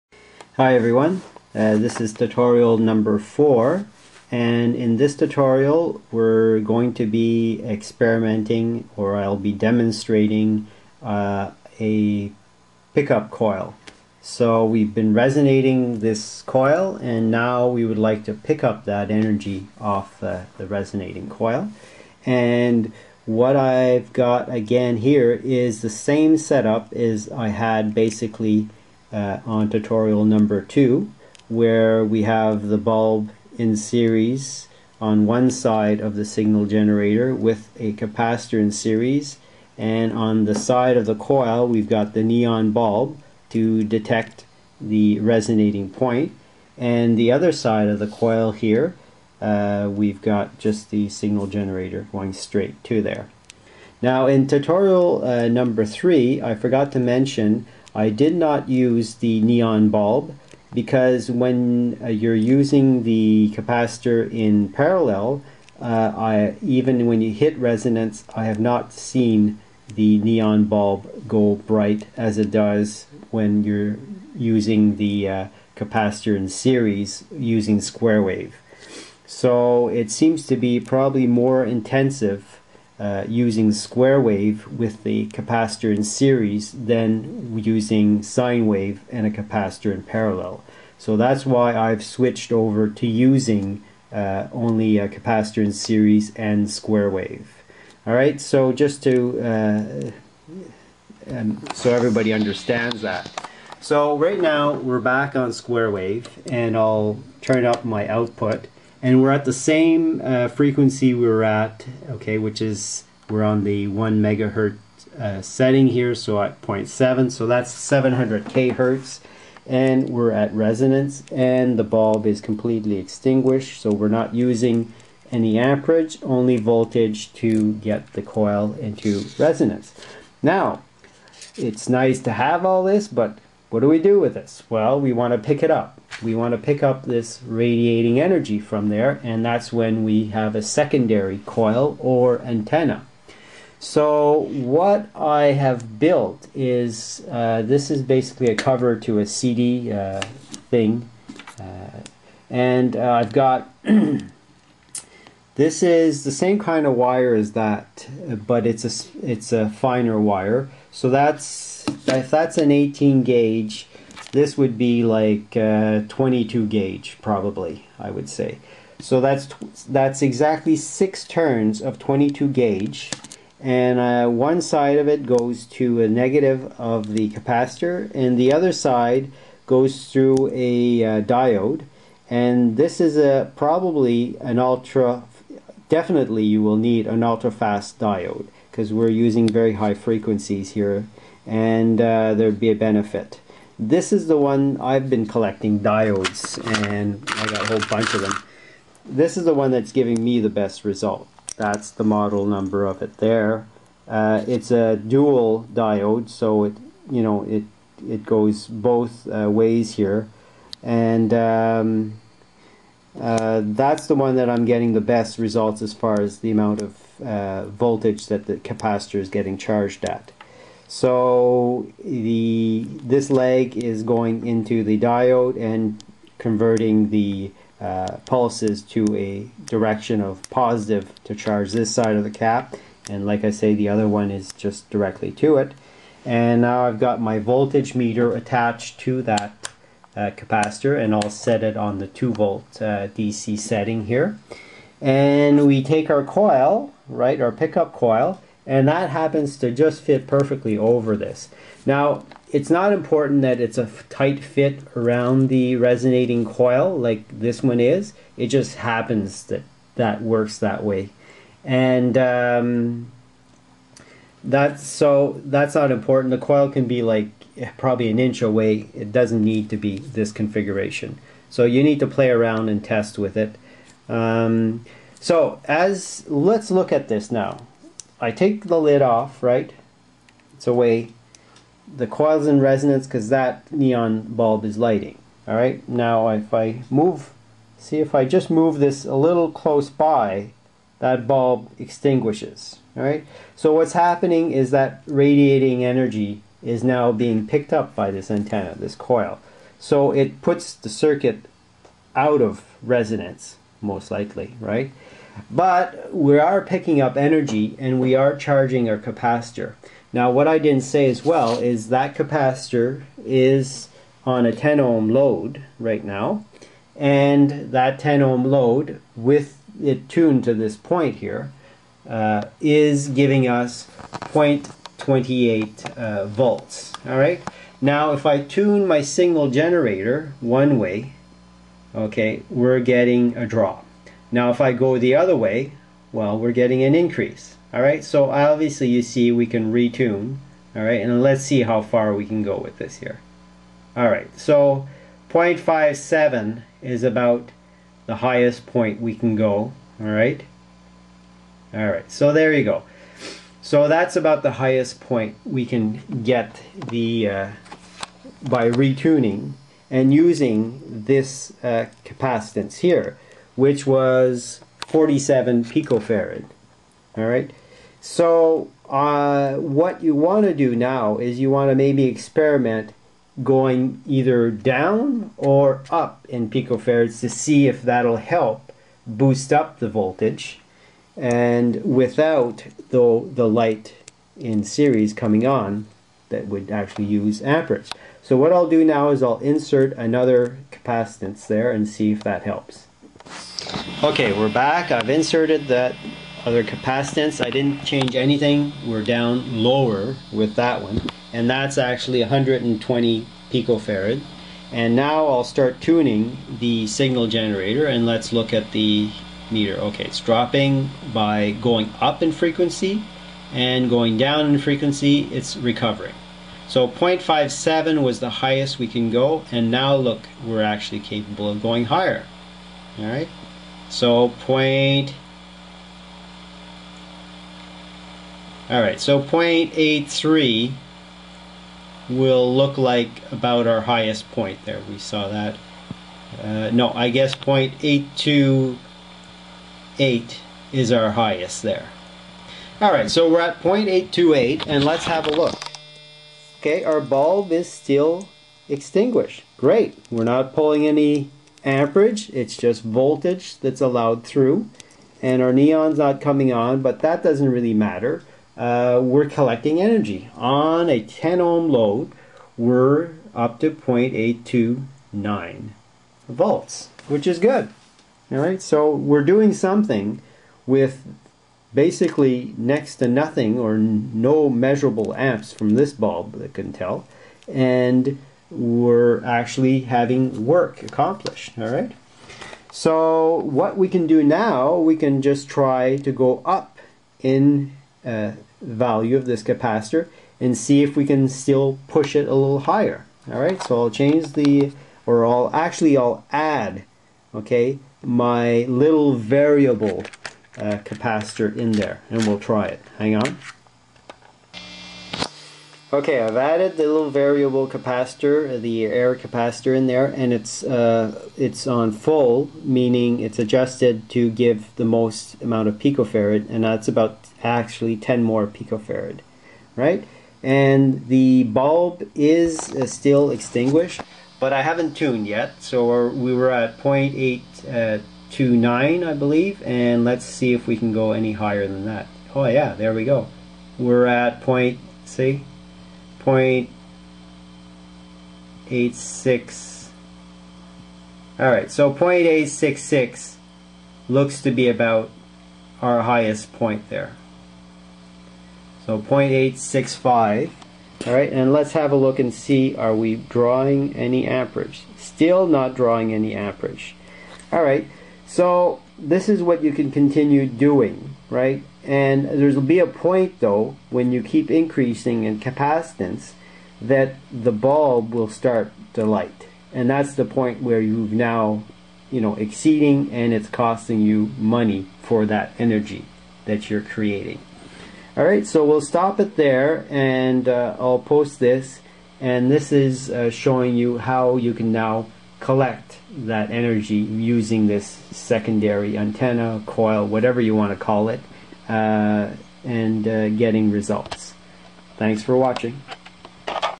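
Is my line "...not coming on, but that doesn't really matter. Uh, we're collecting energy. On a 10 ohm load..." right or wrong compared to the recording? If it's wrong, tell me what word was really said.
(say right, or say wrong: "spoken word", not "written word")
right.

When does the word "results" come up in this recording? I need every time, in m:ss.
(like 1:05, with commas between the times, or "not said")
3:20, 3:35, 9:53.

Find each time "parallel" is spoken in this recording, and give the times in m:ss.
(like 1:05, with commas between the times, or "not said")
1:04, 1:30.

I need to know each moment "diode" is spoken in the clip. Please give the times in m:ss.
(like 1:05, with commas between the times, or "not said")
3:01, 3:07, 3:15, 3:25, 3:44.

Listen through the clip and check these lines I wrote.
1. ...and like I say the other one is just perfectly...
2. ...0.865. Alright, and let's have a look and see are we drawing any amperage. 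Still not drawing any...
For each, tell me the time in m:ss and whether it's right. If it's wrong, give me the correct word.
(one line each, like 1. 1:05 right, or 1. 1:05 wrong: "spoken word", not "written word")
1. 3:53 wrong: "directly", not "perfectly"
2. 9:08 right.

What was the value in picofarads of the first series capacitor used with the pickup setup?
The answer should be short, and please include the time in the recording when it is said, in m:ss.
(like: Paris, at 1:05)
47 picofarad, at 6:04.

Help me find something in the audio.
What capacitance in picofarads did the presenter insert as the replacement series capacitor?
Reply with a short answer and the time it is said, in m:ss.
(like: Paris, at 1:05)
120 picofarad, at 6:42.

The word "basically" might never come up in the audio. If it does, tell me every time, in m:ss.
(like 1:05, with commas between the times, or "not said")
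0:27, 2:28, 7:51.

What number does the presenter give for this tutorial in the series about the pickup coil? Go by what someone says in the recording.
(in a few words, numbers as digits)
4.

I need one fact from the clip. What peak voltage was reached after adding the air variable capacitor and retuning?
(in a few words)
0.866.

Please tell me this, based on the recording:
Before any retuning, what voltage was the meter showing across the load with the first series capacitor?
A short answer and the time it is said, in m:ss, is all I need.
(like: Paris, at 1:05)
0.28 volts, at 5:24.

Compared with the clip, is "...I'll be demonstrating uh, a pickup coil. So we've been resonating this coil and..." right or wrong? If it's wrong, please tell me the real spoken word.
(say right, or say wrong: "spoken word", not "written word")
right.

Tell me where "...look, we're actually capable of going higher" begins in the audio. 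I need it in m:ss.
6:59.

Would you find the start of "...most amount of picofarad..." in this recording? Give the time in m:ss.
8:34.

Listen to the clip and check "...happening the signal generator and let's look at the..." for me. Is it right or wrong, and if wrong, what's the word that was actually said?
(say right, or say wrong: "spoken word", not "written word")
wrong: "tuning", not "happening".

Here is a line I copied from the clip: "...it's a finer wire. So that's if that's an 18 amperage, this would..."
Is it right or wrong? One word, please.
wrong.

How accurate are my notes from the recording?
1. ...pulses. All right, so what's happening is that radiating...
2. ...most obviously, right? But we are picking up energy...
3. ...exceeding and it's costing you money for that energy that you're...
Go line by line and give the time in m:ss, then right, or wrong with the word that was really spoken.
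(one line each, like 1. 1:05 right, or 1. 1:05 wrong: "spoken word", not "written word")
1. 4:51 wrong: "extinguishes", not "pulses"
2. 5:03 wrong: "likely", not "obviously"
3. 9:32 right.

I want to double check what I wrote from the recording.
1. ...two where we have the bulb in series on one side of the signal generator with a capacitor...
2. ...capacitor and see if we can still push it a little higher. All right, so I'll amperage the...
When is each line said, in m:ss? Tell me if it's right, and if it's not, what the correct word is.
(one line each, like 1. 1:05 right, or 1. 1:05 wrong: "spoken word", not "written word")
1. 0:30 right
2. 8:09 wrong: "change", not "amperage".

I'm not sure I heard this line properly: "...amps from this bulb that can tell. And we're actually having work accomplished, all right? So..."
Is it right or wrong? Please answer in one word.
right.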